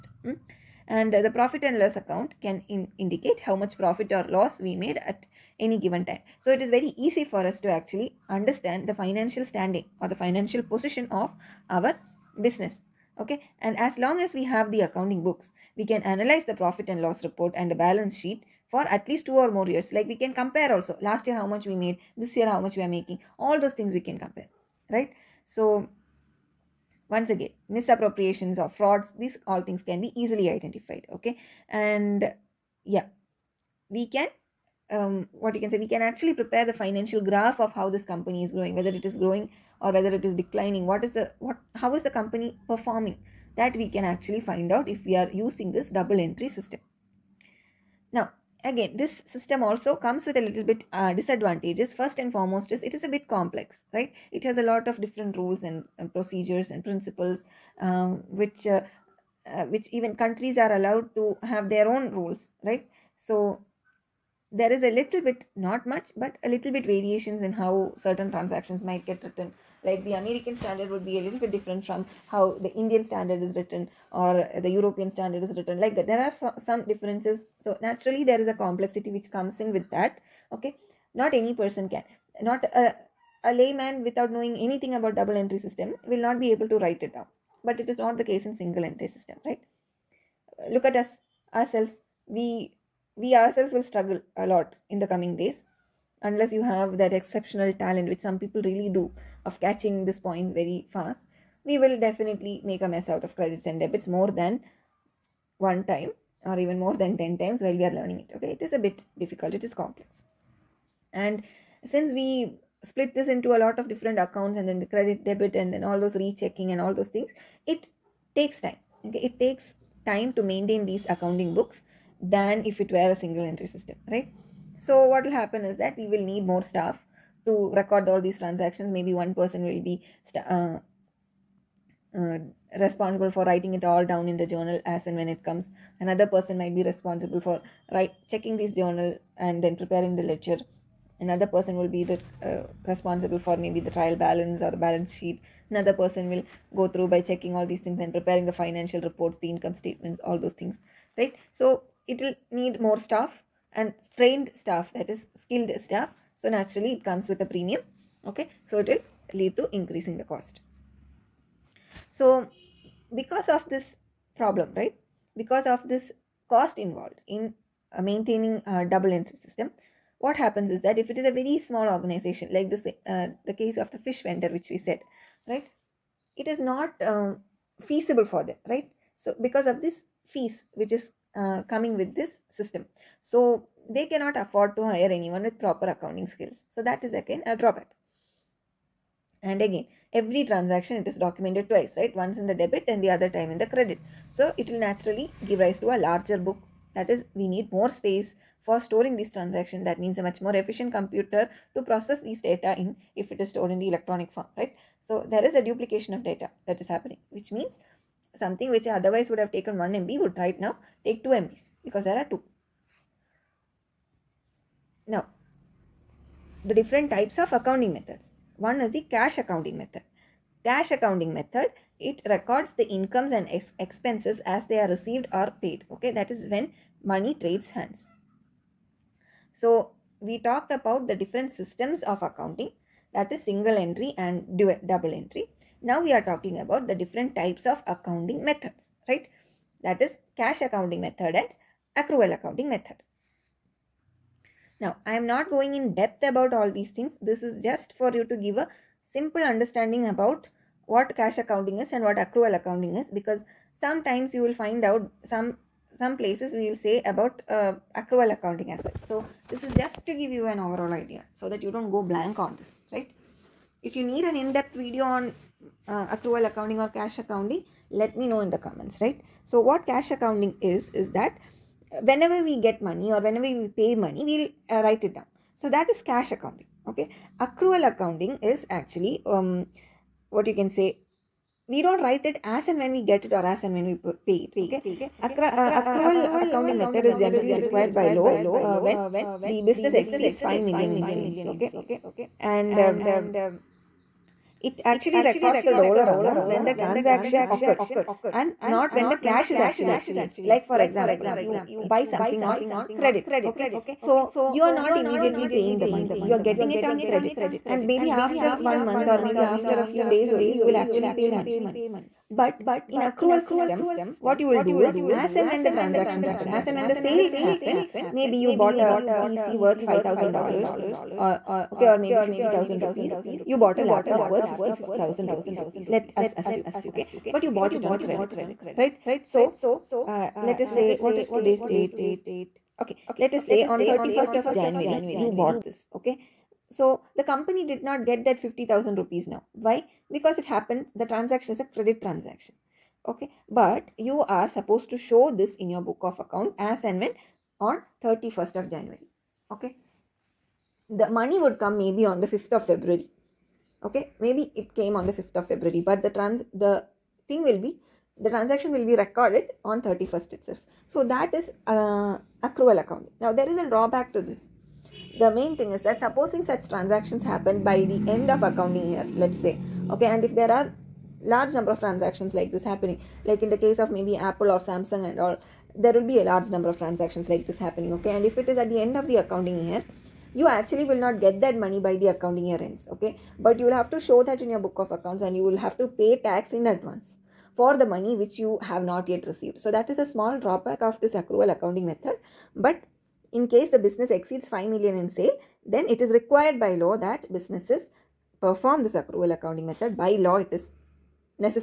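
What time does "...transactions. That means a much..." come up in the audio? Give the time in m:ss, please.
3:19.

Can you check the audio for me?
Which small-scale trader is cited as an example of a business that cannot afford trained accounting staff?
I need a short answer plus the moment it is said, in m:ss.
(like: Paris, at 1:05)
fish vendor, at 2:53.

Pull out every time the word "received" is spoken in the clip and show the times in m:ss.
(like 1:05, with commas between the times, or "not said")
3:44, 6:29.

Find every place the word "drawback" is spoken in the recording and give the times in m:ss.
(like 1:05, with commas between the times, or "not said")
3:07, 6:03, 6:30.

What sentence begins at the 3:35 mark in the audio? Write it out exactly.
Now, the different types of accounting methods.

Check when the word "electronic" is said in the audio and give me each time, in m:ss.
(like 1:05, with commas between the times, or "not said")
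3:23.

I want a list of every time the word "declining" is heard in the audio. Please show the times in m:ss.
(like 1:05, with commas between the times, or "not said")
0:40.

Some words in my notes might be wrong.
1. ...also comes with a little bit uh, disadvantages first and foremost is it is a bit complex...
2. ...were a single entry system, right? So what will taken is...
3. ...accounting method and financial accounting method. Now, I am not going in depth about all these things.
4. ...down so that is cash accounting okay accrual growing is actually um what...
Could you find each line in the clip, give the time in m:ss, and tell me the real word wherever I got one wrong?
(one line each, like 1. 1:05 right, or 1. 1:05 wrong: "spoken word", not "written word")
1. 0:49 right
2. 2:02 wrong: "happen", not "taken"
3. 4:00 wrong: "accrual", not "financial"
4. 4:35 wrong: "accounting", not "growing".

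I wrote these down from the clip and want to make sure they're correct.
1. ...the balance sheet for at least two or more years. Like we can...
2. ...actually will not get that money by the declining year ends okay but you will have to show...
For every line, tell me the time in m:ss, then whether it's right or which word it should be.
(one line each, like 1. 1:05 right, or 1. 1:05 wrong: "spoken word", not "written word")
1. 0:17 right
2. 6:20 wrong: "accounting", not "declining".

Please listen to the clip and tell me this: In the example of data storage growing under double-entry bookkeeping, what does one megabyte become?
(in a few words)
2 MB.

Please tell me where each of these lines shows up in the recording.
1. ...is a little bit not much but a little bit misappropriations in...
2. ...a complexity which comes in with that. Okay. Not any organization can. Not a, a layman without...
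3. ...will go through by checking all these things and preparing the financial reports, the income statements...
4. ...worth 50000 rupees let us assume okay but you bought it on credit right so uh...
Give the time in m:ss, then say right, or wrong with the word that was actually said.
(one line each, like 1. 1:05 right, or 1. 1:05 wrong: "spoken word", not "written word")
1. 1:04 wrong: "variations", not "misappropriations"
2. 1:18 wrong: "person", not "organization"
3. 2:26 right
4. 5:24 right.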